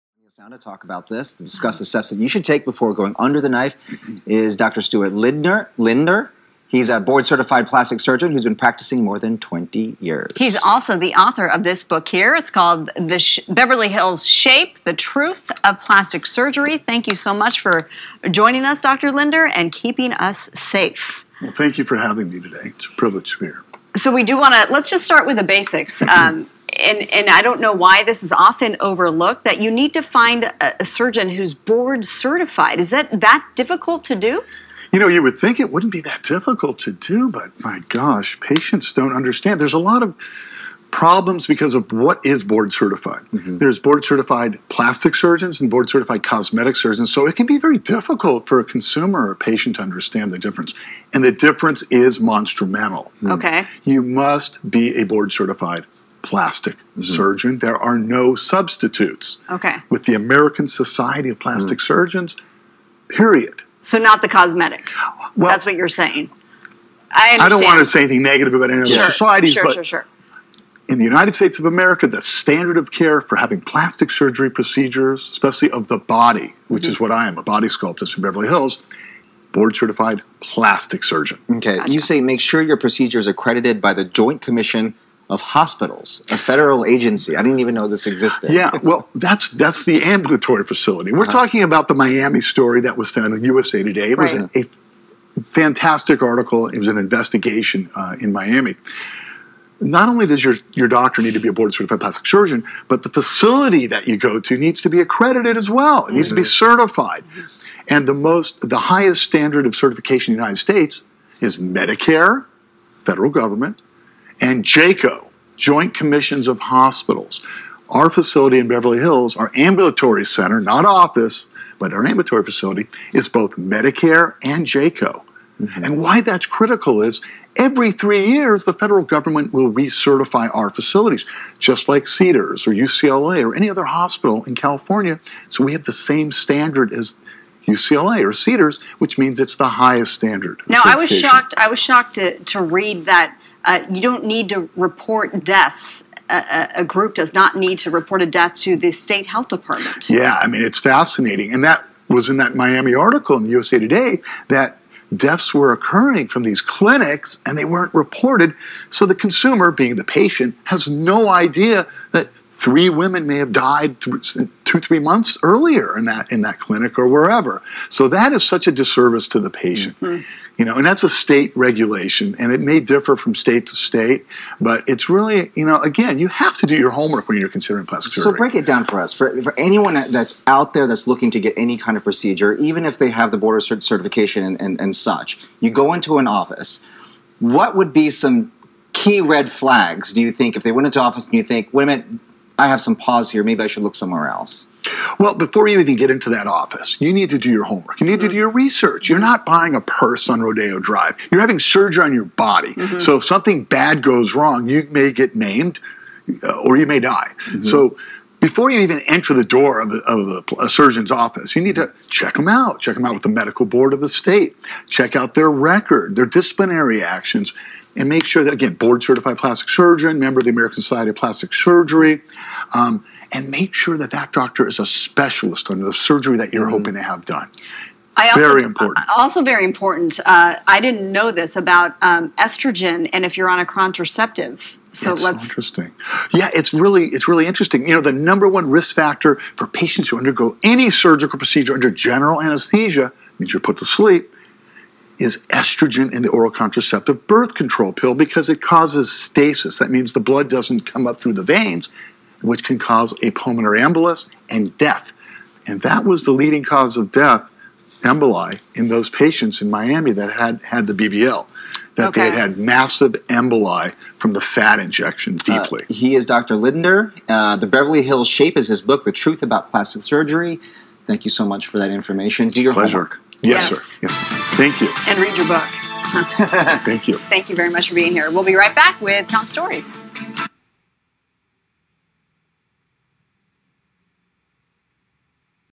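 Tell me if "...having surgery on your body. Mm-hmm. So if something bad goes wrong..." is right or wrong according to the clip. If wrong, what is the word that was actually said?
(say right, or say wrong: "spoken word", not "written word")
right.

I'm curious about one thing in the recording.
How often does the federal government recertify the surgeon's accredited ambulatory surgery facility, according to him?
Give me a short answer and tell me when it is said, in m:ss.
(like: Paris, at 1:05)
Every 3 years, at 2:07.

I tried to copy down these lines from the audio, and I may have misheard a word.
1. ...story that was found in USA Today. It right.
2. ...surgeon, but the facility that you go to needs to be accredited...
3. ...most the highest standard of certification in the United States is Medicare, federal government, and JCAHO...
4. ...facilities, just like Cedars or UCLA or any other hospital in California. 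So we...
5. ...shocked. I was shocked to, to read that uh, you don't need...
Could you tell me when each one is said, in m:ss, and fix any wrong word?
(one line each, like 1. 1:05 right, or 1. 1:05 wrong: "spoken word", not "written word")
1. 1:32 right
2. 1:42 right
3. 1:48 right
4. 2:10 right
5. 2:21 right.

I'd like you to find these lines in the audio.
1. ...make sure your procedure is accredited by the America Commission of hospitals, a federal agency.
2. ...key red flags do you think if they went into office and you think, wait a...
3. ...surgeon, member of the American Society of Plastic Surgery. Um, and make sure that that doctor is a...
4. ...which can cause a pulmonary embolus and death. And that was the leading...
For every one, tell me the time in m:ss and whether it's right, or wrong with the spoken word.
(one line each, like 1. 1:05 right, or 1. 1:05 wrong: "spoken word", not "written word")
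1. 1:22 wrong: "Joint", not "America"
2. 3:08 right
3. 3:39 right
4. 4:12 right.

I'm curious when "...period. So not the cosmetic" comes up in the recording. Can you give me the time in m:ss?
1:03.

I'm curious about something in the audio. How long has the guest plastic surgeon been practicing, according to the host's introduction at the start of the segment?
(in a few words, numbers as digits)
More than 20 years.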